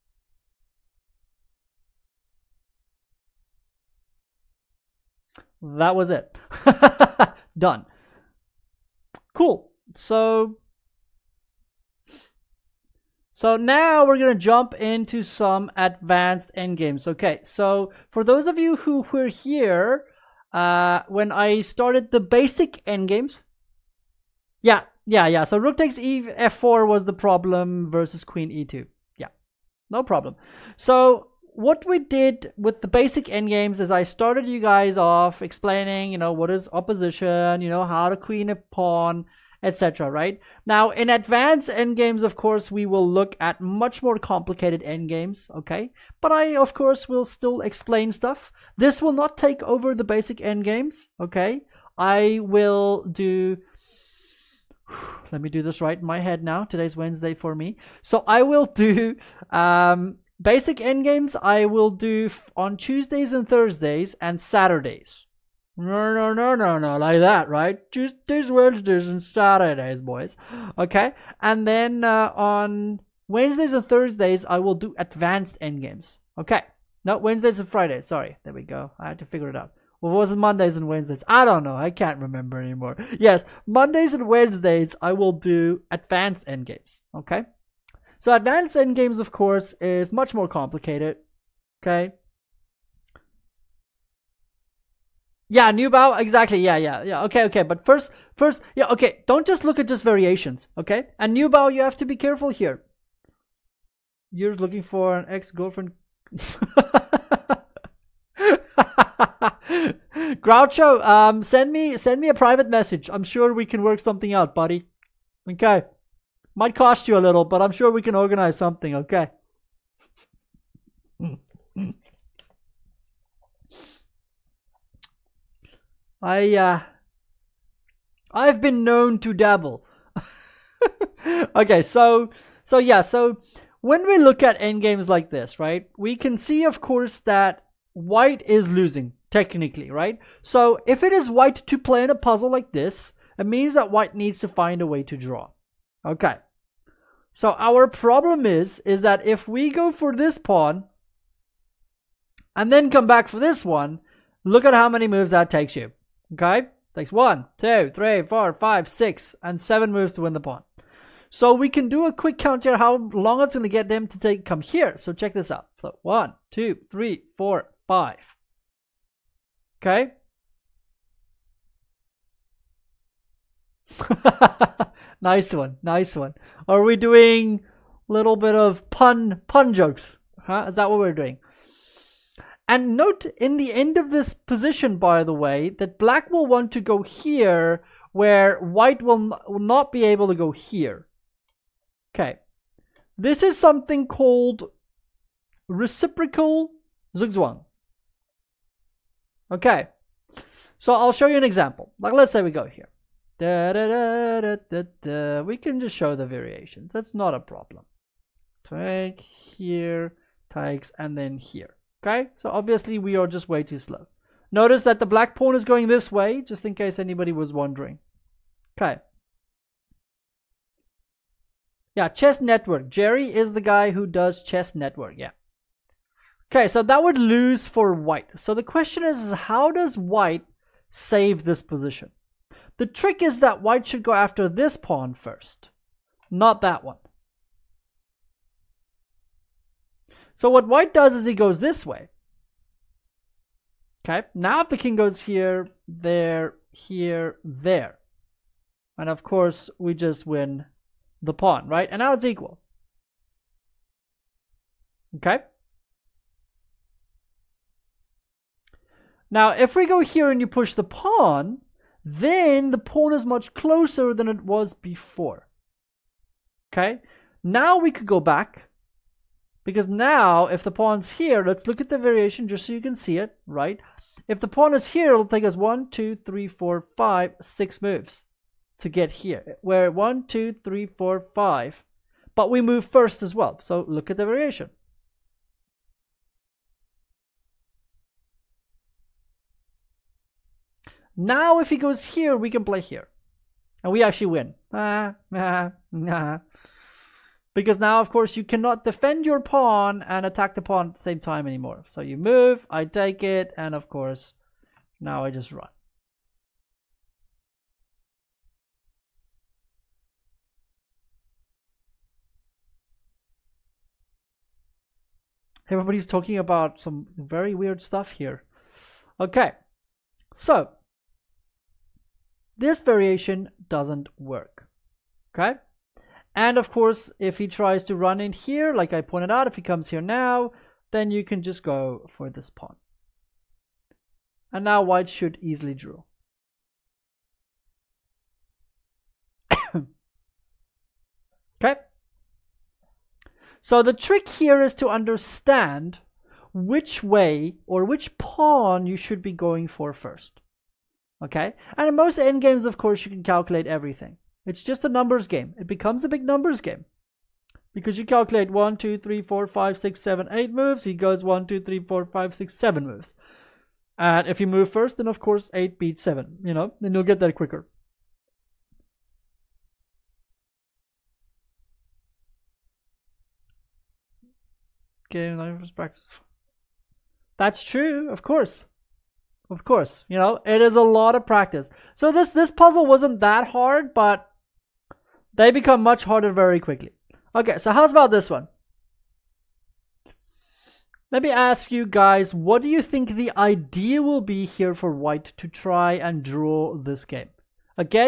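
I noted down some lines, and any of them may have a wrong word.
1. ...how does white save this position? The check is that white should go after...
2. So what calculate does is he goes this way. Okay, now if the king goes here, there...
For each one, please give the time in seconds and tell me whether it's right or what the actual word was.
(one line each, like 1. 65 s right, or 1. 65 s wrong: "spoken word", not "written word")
1. 229 s wrong: "trick", not "check"
2. 240 s wrong: "white", not "calculate".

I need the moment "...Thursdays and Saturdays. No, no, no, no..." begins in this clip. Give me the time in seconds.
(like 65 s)
63 s.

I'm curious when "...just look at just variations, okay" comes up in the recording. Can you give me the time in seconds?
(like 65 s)
99 s.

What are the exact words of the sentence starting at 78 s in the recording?
There we go, I had to figure it out.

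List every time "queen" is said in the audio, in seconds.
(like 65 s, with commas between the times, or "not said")
28 s, 38 s.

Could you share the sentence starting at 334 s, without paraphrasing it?
And now white should easily draw.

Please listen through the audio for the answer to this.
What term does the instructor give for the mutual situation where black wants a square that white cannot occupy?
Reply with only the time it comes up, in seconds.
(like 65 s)
195 s.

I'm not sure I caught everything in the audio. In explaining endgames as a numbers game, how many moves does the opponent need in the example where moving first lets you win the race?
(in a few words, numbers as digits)
7.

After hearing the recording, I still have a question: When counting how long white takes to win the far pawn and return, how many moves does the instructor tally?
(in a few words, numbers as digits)
7.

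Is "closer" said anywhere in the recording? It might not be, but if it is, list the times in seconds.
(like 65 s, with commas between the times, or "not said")
263 s.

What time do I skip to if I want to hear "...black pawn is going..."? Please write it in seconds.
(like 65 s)
215 s.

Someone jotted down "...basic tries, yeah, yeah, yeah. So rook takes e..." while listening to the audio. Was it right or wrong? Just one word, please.
wrong.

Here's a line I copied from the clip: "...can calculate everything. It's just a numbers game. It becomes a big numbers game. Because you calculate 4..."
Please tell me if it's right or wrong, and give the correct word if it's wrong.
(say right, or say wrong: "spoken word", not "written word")
wrong: "1", not "4".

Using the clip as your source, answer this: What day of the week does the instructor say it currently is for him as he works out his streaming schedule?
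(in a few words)
Wednesday.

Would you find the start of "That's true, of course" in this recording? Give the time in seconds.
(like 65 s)
377 s.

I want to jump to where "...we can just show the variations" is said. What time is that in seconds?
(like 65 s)
205 s.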